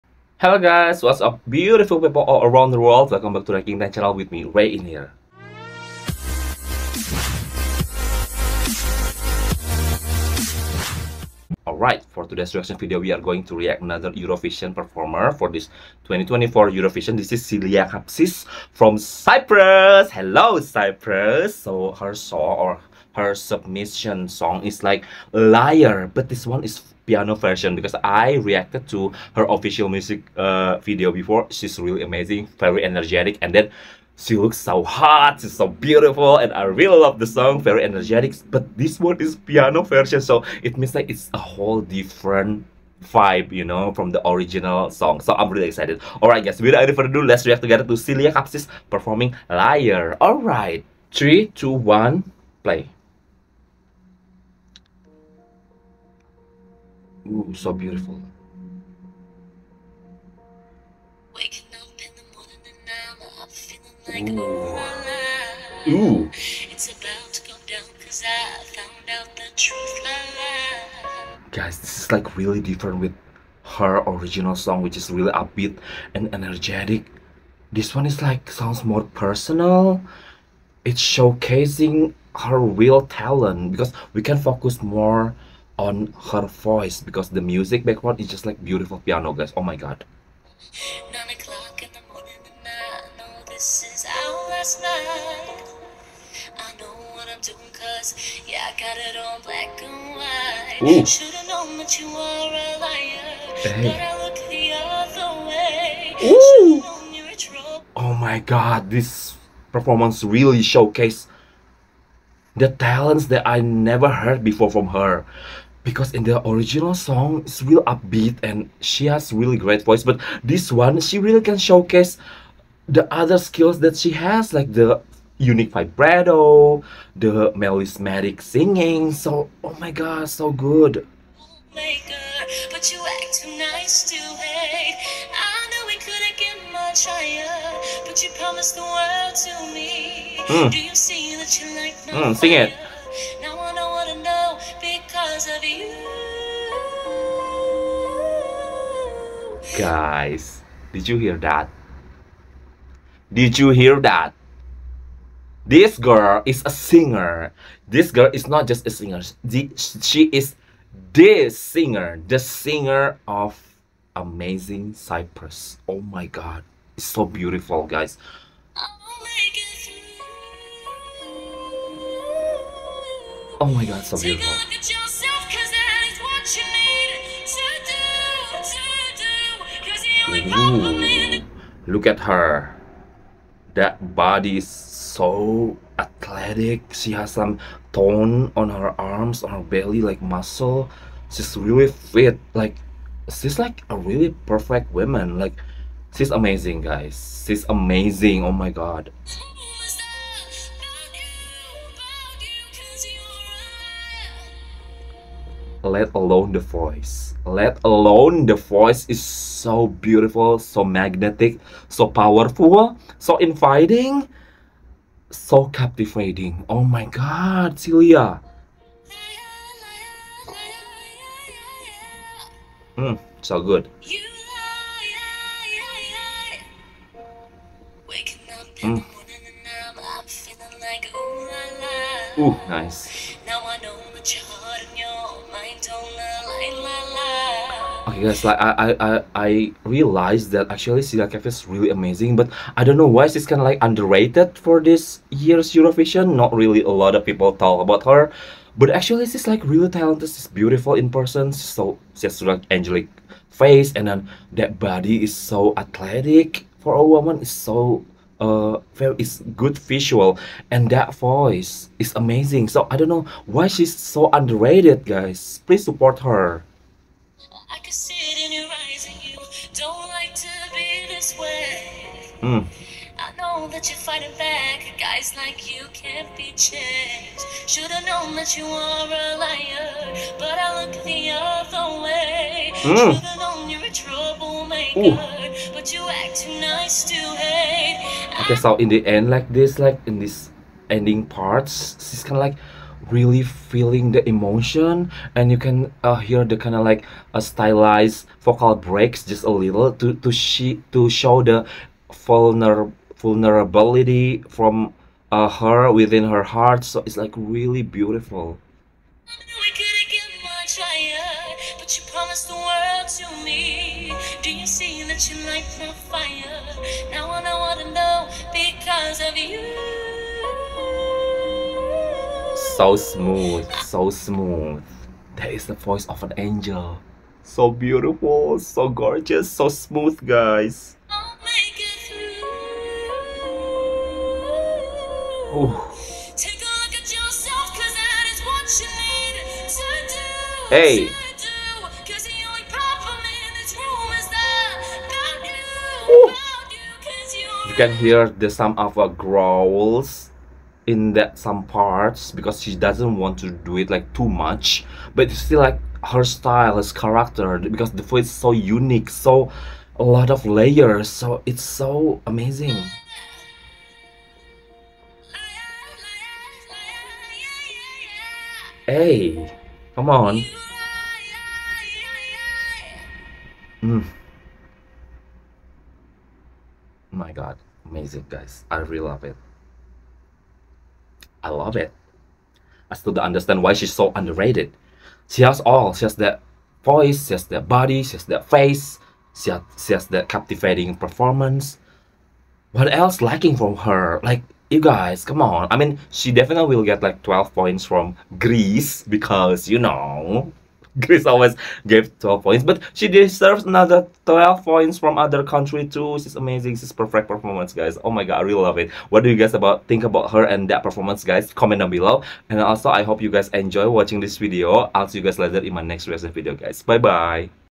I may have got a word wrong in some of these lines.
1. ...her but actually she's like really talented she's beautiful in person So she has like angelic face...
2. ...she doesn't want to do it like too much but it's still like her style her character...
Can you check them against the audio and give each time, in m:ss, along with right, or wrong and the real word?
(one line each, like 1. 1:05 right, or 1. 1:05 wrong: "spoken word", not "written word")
1. 4:08 right
2. 5:52 right.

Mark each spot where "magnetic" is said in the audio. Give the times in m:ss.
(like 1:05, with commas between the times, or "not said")
3:30.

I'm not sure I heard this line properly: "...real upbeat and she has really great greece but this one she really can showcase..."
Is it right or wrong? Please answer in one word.
wrong.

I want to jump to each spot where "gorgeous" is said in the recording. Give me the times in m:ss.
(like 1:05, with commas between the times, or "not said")
5:28.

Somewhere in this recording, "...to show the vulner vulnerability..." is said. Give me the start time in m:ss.
5:00.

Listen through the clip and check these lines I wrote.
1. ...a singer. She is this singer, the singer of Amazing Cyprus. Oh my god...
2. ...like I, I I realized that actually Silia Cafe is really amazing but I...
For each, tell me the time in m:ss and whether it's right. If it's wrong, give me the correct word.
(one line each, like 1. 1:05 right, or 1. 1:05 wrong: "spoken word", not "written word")
1. 2:38 right
2. 3:58 right.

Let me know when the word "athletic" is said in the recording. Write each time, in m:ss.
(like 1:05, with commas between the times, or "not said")
3:05, 4:15.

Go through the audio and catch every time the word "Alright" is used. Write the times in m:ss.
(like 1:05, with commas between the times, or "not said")
0:11, 0:46, 0:50.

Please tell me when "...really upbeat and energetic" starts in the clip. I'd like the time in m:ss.
1:15.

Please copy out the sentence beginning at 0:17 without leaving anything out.
This is Silia Kapsis from Cyprus.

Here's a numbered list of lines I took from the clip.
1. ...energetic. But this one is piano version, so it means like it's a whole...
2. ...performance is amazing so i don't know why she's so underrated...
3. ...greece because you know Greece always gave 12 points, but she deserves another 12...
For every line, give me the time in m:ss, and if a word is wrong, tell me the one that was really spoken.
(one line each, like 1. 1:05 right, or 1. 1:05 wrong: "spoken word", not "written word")
1. 0:37 right
2. 4:21 wrong: "voice", not "performance"
3. 6:38 right.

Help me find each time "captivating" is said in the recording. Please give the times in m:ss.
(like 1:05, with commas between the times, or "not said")
3:35, 6:30.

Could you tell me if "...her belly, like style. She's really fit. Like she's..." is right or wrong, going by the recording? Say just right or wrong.
wrong.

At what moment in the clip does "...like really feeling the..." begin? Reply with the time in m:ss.
4:52.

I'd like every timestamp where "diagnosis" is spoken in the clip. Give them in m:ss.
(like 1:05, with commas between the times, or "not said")
not said.